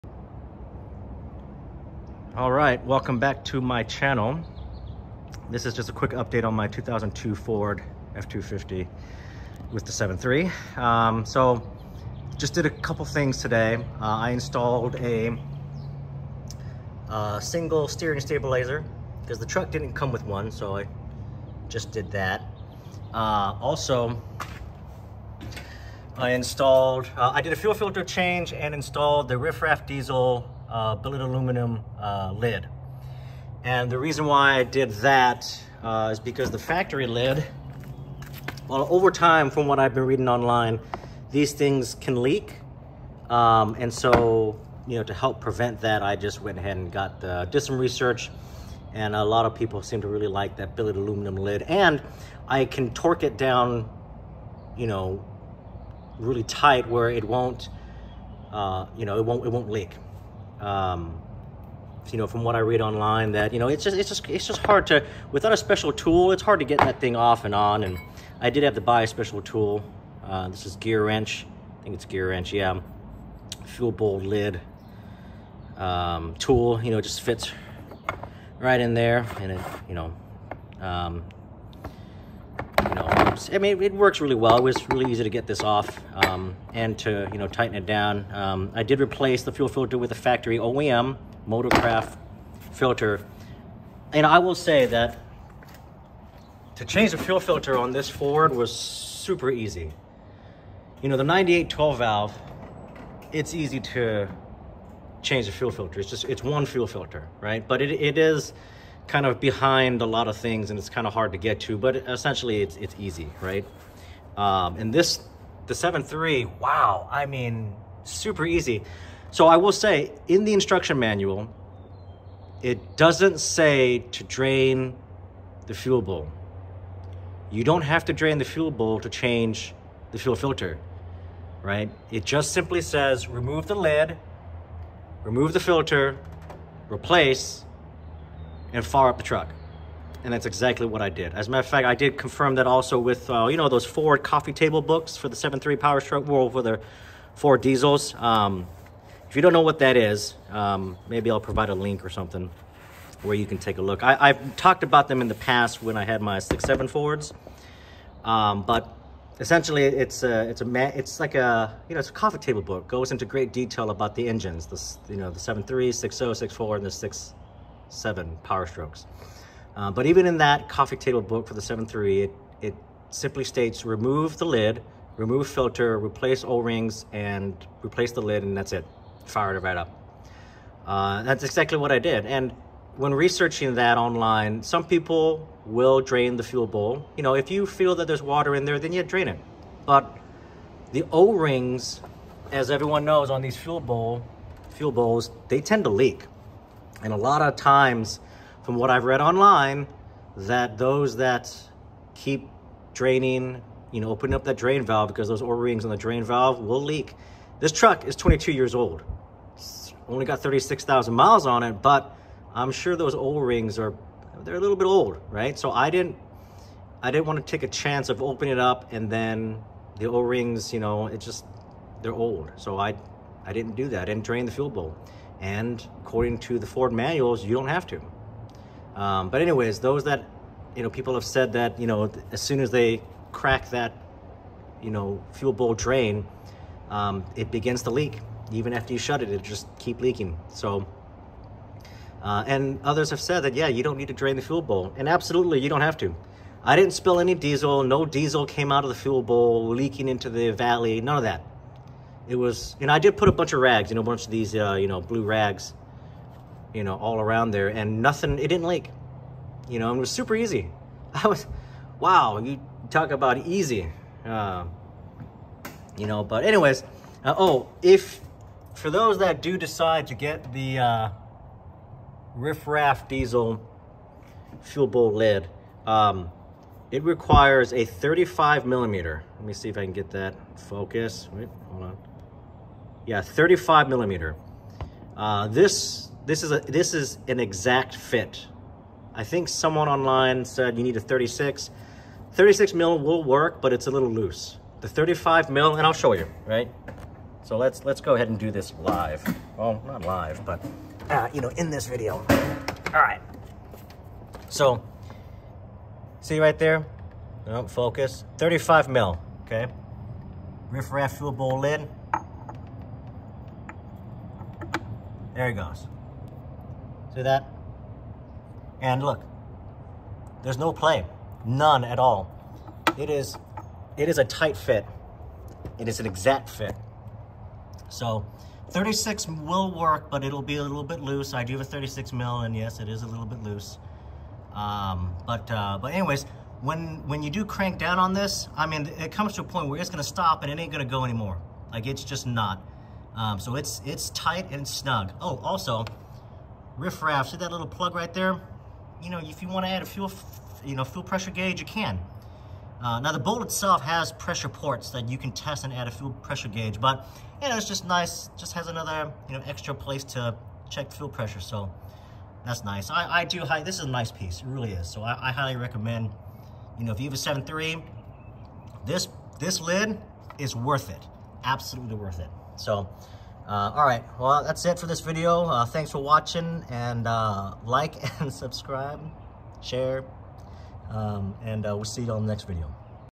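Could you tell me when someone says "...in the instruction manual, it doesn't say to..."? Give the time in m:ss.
2:00.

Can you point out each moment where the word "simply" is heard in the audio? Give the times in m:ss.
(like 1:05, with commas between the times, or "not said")
2:12, 2:53.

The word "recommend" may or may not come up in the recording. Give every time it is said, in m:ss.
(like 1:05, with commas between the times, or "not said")
6:05.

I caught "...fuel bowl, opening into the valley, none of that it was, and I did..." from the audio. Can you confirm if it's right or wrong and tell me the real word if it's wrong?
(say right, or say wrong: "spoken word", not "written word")
wrong: "leaking", not "opening".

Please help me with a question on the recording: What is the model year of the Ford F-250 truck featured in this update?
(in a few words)
2002.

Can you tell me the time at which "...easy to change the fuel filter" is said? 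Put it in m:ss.
1:43.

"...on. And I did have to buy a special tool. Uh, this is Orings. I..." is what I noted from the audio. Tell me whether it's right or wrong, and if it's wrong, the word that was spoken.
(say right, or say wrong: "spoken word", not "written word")
wrong: "GearWrench", not "Orings".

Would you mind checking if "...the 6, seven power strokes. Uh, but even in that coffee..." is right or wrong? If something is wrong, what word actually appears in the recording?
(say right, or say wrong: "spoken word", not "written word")
right.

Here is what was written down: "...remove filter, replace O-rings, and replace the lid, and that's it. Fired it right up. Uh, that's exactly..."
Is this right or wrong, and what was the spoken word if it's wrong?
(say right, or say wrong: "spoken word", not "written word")
right.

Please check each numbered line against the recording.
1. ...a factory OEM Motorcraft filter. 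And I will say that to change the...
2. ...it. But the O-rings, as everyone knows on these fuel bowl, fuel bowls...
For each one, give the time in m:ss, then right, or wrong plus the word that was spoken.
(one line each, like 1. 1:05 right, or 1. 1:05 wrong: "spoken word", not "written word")
1. 1:30 right
2. 3:09 right.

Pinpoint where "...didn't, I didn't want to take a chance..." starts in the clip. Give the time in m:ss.
3:35.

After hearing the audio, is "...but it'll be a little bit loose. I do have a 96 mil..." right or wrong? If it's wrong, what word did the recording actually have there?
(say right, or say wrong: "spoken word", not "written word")
wrong: "36", not "96".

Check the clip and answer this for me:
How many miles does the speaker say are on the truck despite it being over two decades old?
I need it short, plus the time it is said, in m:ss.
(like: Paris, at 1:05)
36,000, at 3:30.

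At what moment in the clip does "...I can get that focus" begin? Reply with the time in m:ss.
4:39.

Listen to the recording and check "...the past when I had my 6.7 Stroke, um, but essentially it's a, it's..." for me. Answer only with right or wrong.
wrong.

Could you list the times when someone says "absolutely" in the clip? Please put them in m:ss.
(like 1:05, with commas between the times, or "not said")
4:05, 6:11.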